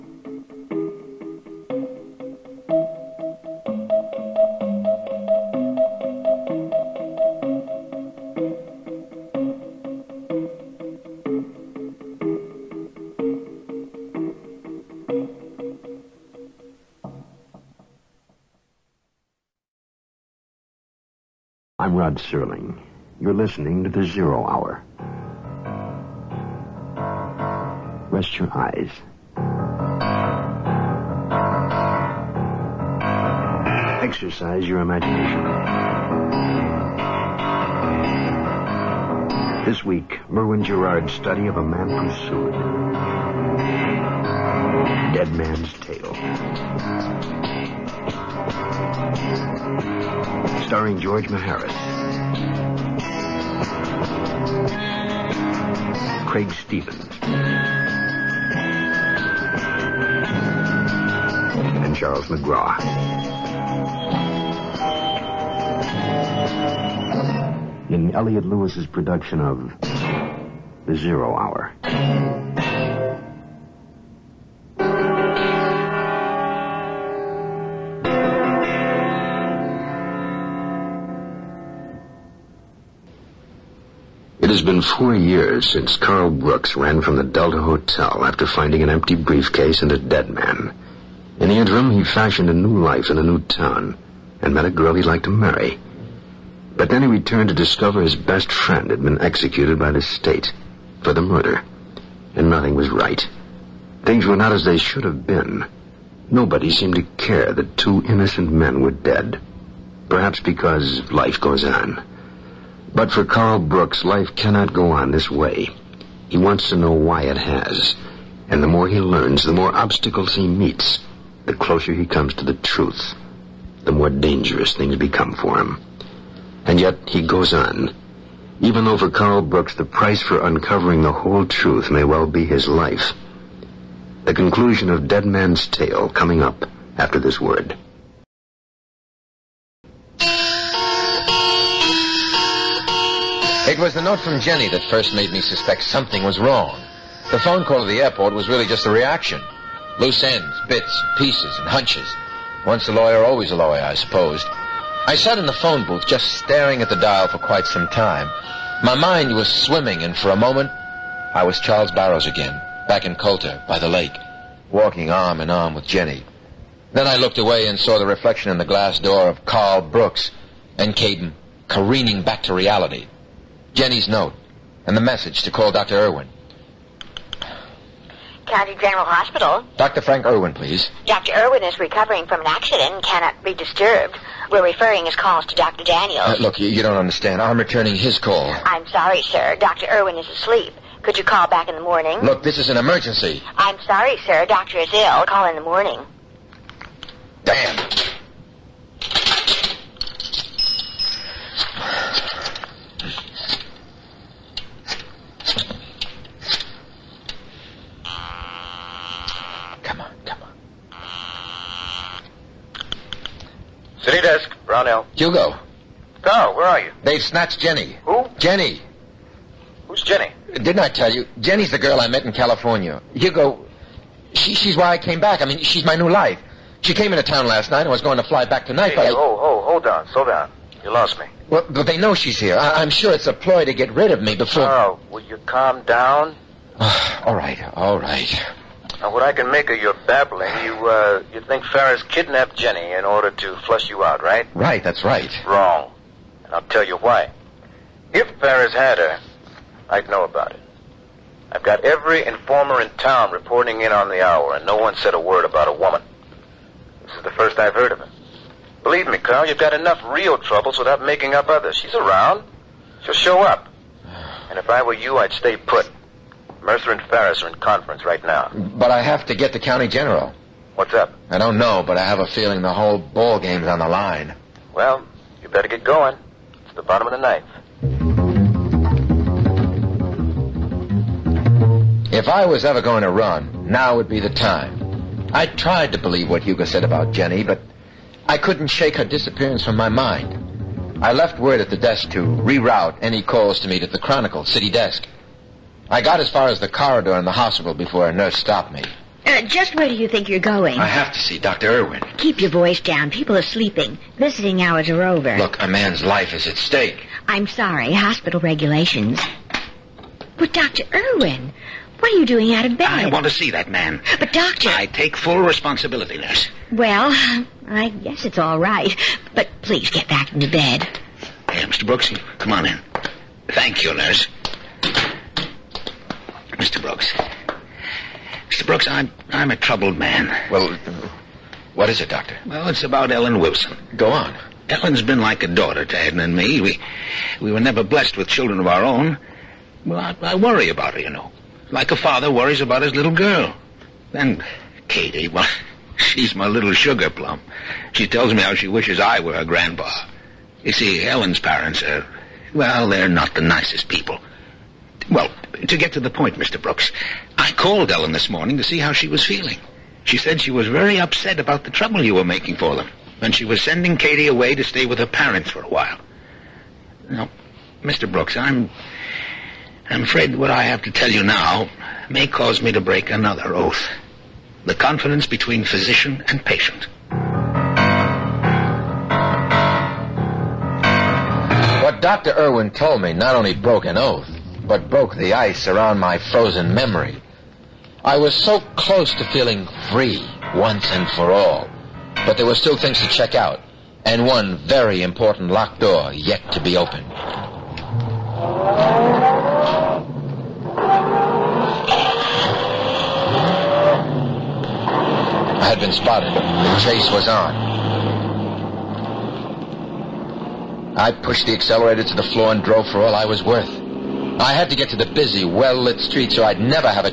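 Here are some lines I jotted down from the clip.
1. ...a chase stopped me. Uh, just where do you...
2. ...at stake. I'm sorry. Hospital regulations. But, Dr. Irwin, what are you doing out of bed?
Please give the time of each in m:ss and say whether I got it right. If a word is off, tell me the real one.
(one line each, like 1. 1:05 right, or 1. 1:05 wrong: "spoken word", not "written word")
1. 4:58 wrong: "nurse", not "chase"
2. 5:06 right.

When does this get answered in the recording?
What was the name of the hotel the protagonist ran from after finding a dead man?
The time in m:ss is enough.
1:27.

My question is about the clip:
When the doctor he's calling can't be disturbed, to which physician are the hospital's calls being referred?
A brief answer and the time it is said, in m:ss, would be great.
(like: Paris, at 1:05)
Dr. Daniels, at 3:05.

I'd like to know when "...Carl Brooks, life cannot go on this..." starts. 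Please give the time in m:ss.
1:53.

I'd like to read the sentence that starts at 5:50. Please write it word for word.
You see, Ellen's parents are, well, they're not the nicest people.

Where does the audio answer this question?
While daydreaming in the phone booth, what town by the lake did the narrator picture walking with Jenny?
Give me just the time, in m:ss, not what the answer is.
2:43.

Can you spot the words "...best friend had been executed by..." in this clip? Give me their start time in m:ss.
1:38.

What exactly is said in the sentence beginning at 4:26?
Mercer and Ferris are in conference right now.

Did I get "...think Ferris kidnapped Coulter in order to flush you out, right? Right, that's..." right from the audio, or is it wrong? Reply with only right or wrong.
wrong.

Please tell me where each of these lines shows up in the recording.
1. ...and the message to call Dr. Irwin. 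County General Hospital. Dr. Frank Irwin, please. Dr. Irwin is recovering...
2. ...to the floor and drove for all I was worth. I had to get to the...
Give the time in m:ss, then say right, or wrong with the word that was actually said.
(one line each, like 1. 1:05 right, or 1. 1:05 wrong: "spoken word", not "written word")
1. 2:54 right
2. 6:52 right.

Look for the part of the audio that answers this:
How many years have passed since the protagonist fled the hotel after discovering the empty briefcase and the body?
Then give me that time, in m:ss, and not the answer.
1:24.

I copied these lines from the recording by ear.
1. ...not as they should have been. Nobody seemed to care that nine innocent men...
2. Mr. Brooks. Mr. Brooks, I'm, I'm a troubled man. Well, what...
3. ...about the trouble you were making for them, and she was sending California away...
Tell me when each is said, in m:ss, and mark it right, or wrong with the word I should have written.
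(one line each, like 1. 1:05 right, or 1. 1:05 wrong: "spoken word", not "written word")
1. 1:44 wrong: "two", not "nine"
2. 5:26 right
3. 6:01 wrong: "Katie", not "California".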